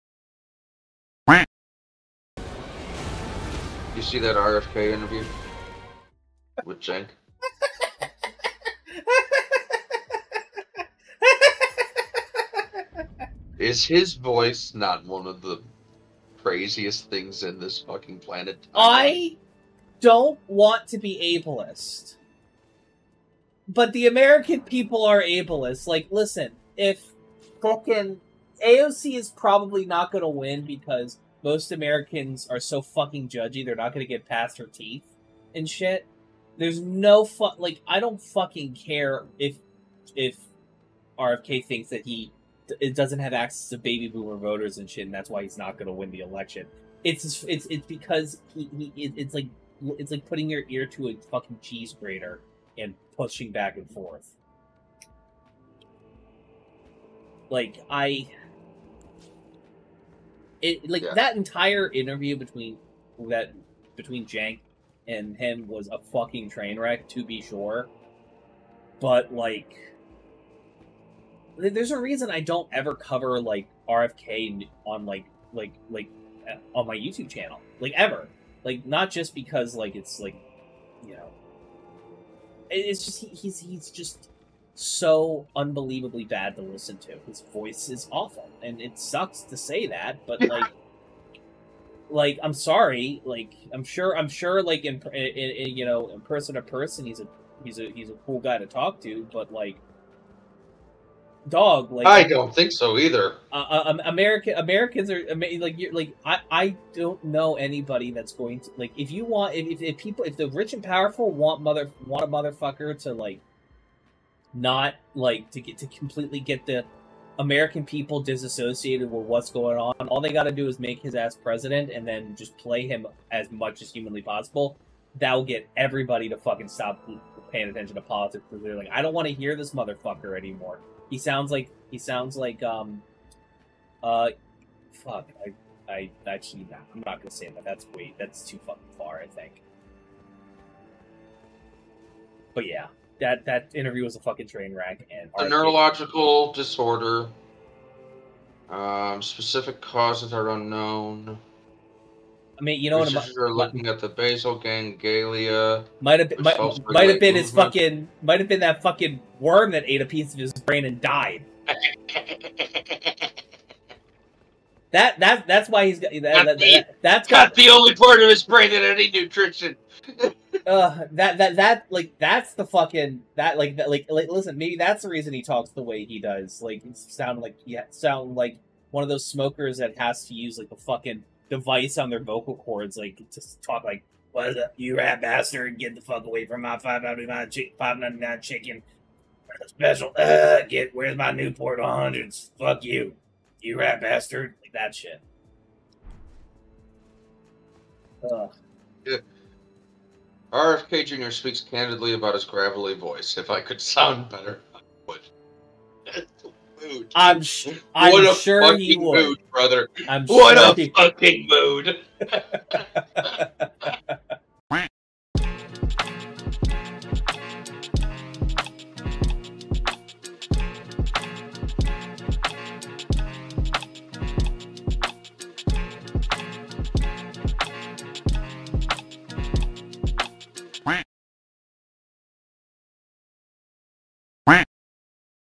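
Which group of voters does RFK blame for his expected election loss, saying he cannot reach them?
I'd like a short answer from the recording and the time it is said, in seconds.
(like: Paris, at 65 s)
baby boomer voters, at 43 s.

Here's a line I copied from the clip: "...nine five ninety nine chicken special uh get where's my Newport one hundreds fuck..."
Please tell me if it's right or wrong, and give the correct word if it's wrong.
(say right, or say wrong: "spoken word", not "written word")
right.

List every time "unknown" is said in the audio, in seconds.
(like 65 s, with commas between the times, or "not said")
150 s.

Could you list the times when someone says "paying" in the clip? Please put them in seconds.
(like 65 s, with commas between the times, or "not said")
127 s.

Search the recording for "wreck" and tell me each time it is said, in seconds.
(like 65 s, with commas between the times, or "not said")
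66 s, 144 s.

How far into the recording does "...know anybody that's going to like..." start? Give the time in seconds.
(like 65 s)
107 s.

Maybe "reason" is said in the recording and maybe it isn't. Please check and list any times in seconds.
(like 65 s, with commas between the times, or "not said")
71 s, 175 s.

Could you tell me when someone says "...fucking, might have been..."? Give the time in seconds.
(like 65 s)
157 s.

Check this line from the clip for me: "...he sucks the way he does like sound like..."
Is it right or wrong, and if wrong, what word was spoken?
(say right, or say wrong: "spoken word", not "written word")
wrong: "talks", not "sucks".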